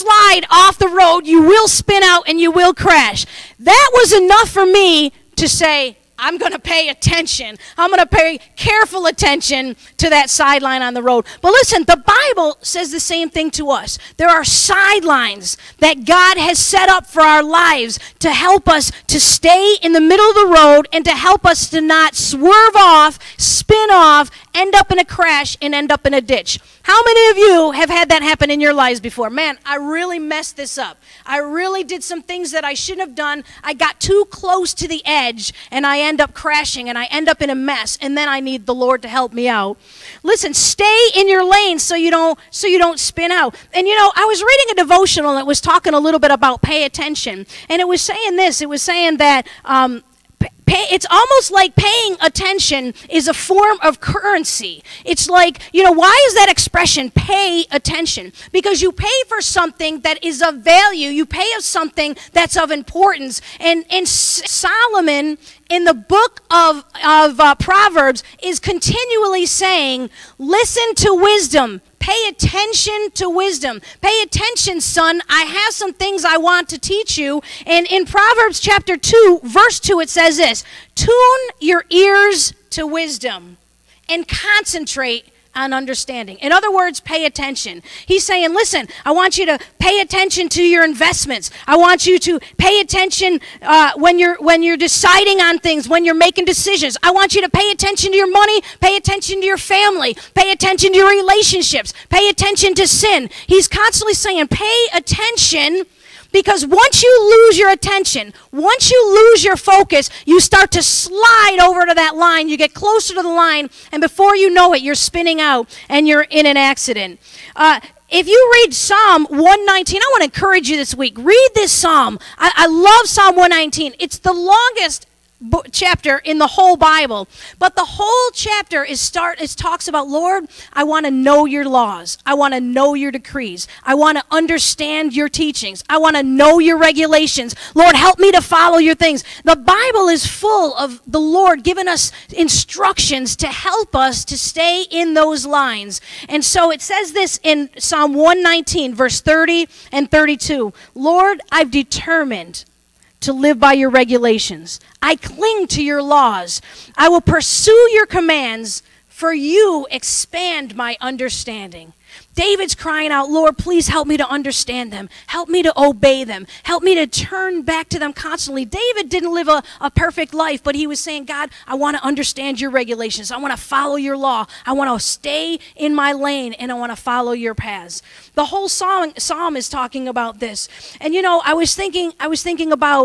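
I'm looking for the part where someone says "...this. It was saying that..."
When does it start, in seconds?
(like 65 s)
48 s.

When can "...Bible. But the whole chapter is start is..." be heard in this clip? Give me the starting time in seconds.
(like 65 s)
126 s.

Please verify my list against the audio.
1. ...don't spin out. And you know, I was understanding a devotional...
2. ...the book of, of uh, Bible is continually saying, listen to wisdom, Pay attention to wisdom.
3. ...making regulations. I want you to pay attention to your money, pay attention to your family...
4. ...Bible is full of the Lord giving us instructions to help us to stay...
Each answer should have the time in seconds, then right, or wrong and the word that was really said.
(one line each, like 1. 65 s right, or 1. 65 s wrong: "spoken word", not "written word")
1. 42 s wrong: "reading", not "understanding"
2. 65 s wrong: "Proverbs", not "Bible"
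3. 96 s wrong: "decisions", not "regulations"
4. 139 s right.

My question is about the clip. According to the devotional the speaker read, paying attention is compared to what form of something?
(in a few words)
currency.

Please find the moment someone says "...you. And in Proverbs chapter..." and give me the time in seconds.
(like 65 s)
77 s.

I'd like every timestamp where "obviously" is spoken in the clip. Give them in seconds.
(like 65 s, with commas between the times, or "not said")
not said.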